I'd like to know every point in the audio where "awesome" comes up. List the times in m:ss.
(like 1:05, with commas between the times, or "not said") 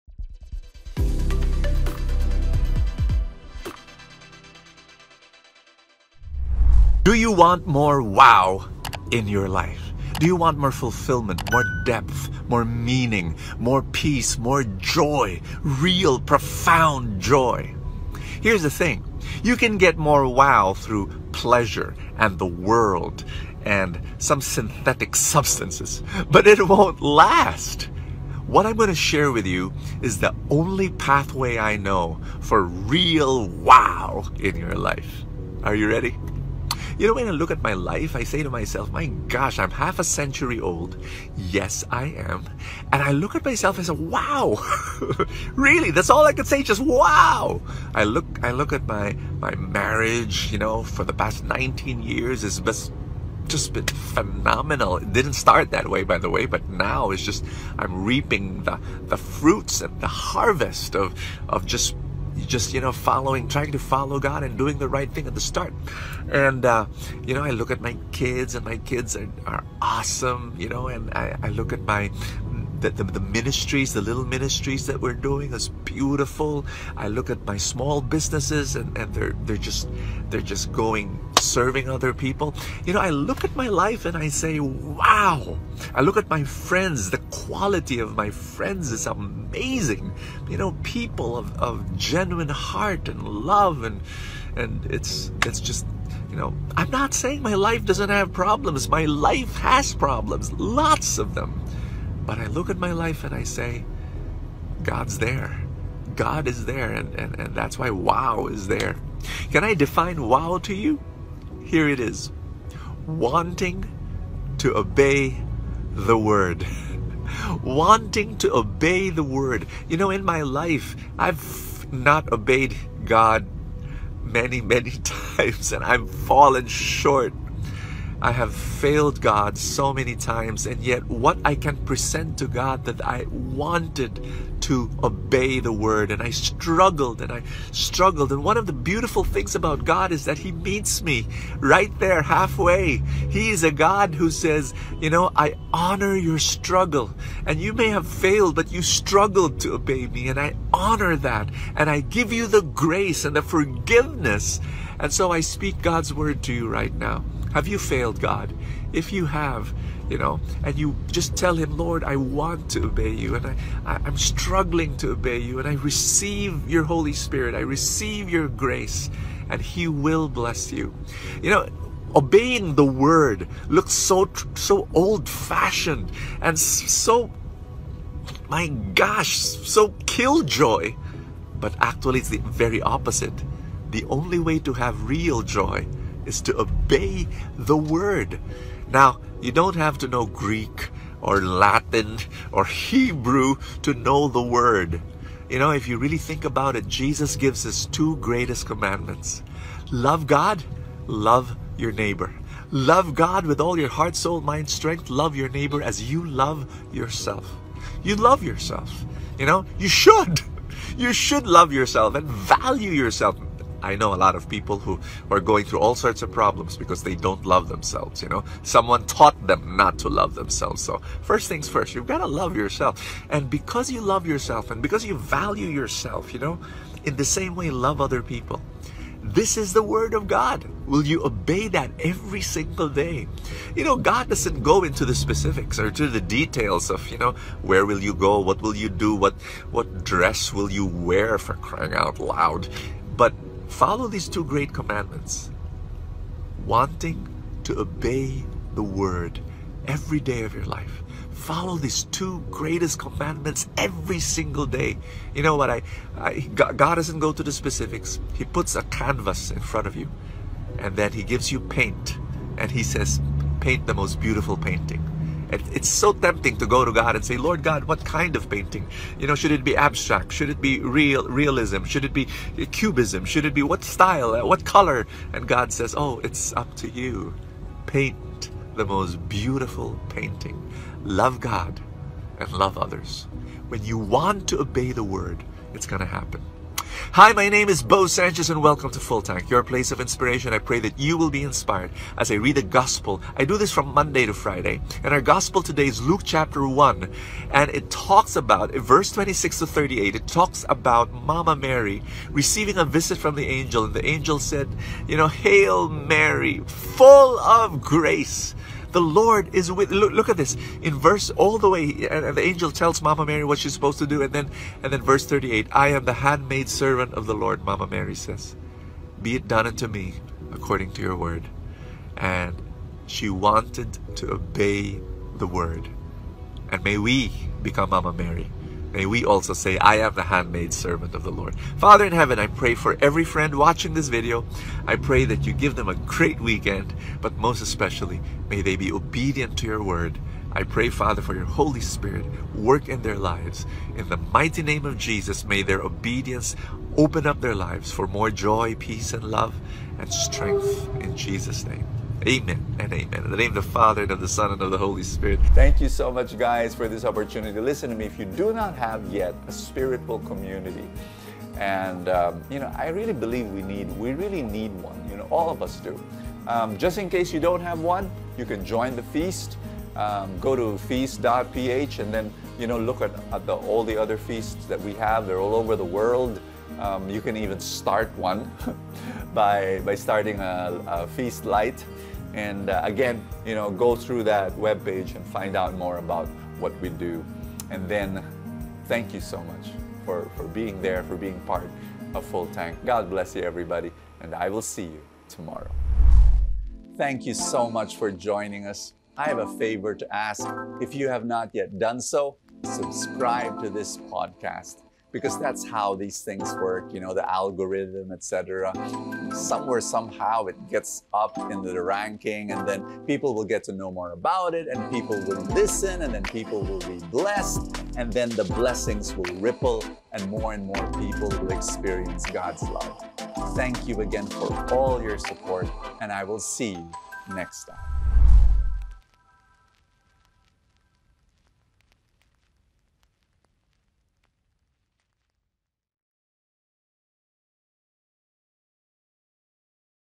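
1:09.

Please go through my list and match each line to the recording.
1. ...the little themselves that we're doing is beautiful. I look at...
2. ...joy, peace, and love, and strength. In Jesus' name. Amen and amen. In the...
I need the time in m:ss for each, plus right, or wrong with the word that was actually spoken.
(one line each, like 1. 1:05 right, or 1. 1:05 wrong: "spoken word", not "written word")
1. 1:13 wrong: "ministries", not "themselves"
2. 5:48 right.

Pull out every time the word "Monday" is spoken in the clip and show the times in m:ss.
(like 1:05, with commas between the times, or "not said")
4:53.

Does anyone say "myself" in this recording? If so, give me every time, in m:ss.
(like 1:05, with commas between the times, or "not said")
0:38, 0:43.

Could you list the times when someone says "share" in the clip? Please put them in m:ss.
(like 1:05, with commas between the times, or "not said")
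0:28.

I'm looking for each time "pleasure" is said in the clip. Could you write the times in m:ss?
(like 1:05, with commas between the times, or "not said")
0:21.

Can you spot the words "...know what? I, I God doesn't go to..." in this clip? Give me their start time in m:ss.
4:15.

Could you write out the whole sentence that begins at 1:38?
My life has problems, lots of them.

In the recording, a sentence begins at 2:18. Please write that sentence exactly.
And one of the beautiful things about God is that He meets me right there halfway.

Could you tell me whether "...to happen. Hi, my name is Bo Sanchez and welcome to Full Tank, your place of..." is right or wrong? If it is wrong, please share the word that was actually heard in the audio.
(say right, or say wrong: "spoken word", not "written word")
right.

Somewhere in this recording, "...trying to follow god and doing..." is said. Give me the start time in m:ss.
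1:03.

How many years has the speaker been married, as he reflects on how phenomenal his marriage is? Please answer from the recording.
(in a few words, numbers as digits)
19.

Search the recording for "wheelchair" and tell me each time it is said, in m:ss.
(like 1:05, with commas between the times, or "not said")
not said.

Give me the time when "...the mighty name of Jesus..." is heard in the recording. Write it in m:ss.
5:44.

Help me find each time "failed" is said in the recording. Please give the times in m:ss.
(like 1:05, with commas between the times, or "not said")
2:08, 2:28, 2:37.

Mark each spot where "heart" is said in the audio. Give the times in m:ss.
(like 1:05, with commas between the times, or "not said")
1:32, 3:23.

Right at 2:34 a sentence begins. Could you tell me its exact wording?
And so I speak God's word to you right now.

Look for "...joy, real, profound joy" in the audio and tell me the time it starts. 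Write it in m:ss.
0:14.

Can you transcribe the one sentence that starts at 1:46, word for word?
God is there, and, and, and that's why wow is there.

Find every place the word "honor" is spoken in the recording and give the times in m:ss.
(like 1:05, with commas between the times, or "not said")
2:25, 2:30.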